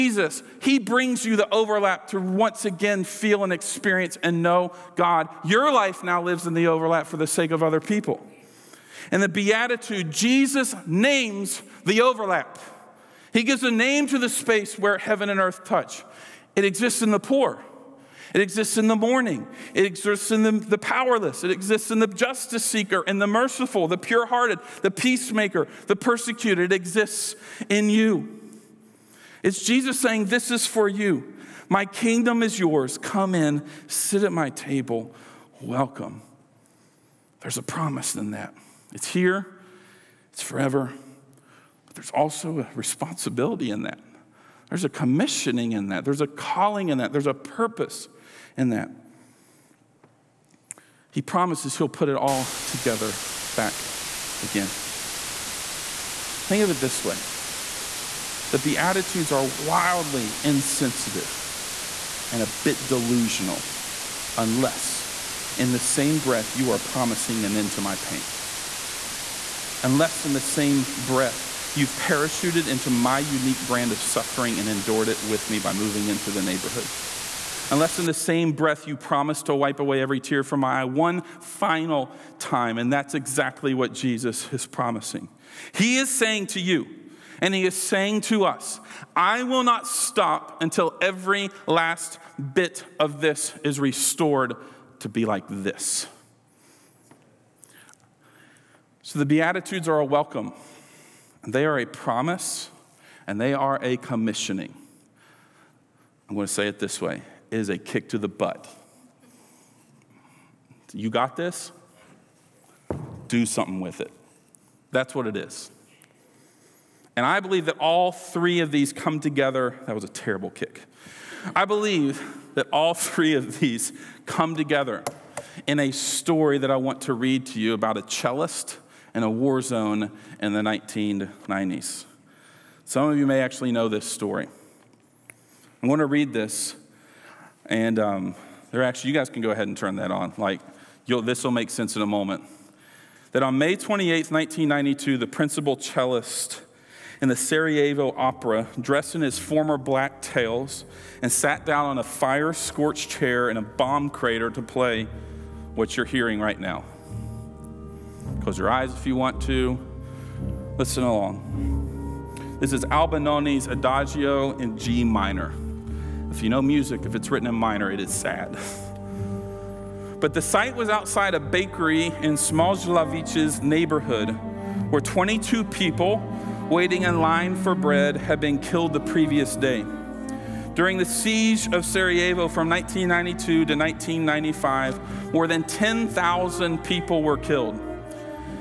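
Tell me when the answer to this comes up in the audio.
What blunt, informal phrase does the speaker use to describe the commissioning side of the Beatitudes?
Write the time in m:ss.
1:47.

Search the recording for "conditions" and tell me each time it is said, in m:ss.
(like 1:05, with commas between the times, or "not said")
not said.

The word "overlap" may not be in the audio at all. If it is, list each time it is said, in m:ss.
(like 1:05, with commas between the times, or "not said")
0:01, 0:06, 0:12.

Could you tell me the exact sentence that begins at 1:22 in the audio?
And that's exactly what Jesus is promising.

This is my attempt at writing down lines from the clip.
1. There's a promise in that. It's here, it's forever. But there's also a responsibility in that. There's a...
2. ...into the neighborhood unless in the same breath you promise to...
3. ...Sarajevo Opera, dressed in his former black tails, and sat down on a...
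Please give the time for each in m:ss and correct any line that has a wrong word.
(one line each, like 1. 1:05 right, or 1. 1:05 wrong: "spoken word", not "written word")
1. 0:37 right
2. 1:16 right
3. 2:27 right.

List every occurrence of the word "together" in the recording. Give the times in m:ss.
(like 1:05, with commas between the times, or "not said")
0:52, 1:59, 2:04.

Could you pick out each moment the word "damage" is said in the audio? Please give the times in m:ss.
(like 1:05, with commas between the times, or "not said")
not said.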